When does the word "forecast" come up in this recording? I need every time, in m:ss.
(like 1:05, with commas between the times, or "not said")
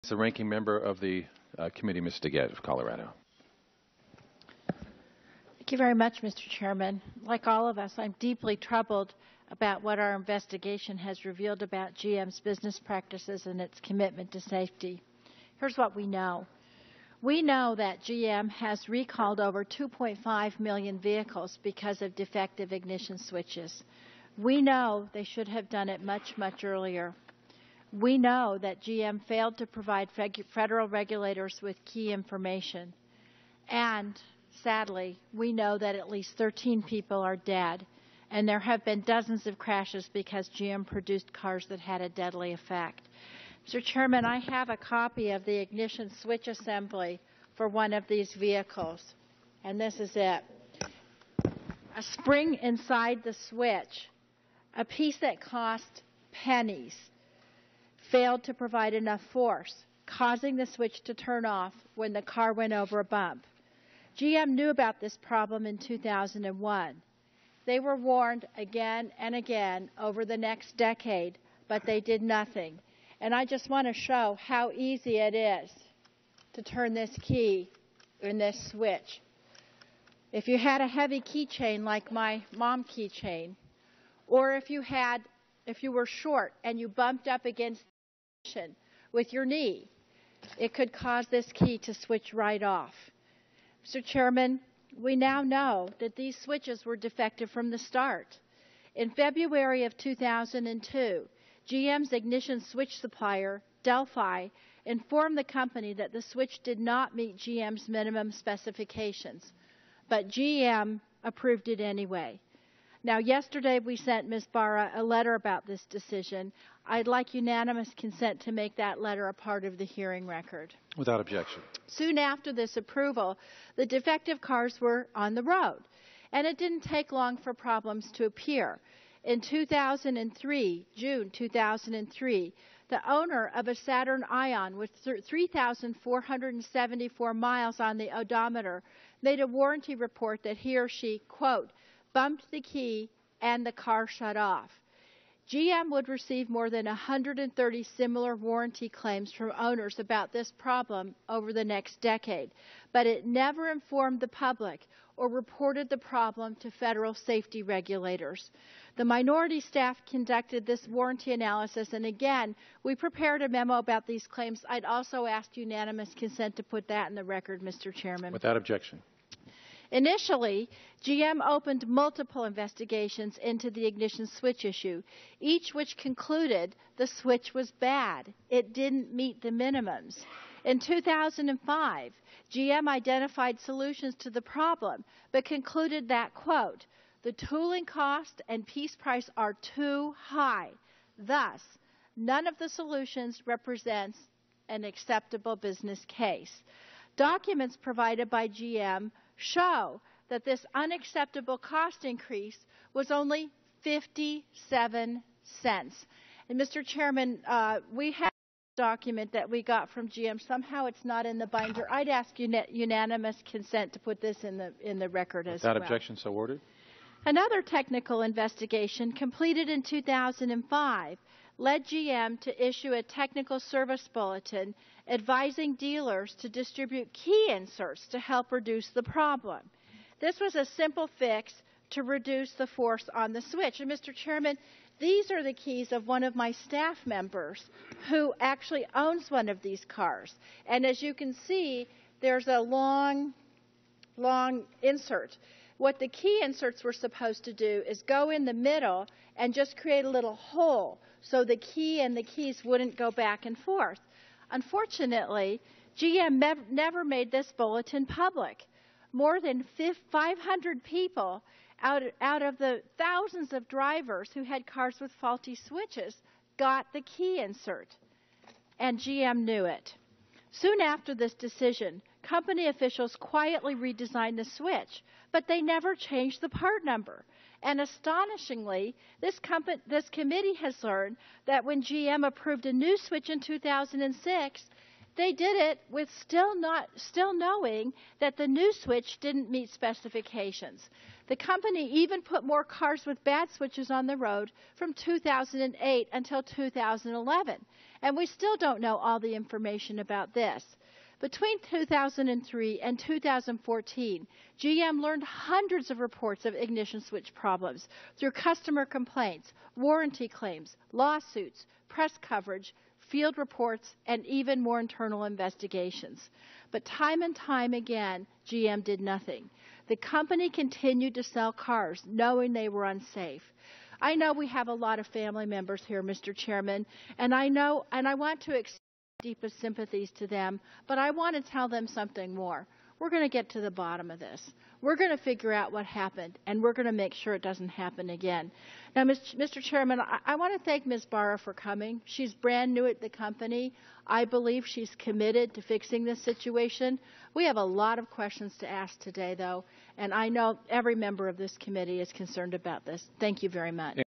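not said.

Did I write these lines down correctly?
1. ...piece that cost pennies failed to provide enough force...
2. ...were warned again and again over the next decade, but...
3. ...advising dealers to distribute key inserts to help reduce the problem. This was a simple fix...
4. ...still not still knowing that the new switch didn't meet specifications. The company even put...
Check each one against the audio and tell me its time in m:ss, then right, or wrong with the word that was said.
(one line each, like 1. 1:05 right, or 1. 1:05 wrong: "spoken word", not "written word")
1. 0:54 right
2. 1:07 right
3. 3:45 right
4. 4:46 right.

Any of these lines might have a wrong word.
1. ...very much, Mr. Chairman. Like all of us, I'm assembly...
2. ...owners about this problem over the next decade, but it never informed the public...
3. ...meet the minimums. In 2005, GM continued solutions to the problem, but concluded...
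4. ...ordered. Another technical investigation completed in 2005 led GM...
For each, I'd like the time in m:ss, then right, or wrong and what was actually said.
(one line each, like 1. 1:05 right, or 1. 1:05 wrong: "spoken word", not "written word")
1. 0:05 wrong: "deeply", not "assembly"
2. 2:29 right
3. 2:59 wrong: "identified", not "continued"
4. 3:36 right.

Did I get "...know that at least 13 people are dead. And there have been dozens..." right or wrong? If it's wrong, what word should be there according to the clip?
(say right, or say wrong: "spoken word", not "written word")
right.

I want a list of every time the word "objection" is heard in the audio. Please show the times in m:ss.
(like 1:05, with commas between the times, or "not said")
2:01, 2:48, 3:35.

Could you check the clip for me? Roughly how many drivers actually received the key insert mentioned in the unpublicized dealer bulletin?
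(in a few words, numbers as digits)
More than 500.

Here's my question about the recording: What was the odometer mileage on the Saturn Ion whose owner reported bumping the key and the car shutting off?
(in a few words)
3,474 miles.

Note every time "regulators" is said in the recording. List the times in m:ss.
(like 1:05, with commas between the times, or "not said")
0:30, 2:37.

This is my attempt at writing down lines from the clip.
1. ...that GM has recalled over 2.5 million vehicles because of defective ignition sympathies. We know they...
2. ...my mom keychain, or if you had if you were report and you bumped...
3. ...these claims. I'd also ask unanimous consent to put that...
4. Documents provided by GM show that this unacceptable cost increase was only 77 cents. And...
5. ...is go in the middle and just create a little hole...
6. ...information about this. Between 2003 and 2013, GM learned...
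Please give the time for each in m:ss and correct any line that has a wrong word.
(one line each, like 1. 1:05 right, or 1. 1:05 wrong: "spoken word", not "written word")
1. 0:17 wrong: "switches", not "sympathies"
2. 1:22 wrong: "short", not "report"
3. 2:44 right
4. 3:17 wrong: "57", not "77"
5. 4:07 right
6. 4:59 wrong: "2014", not "2013".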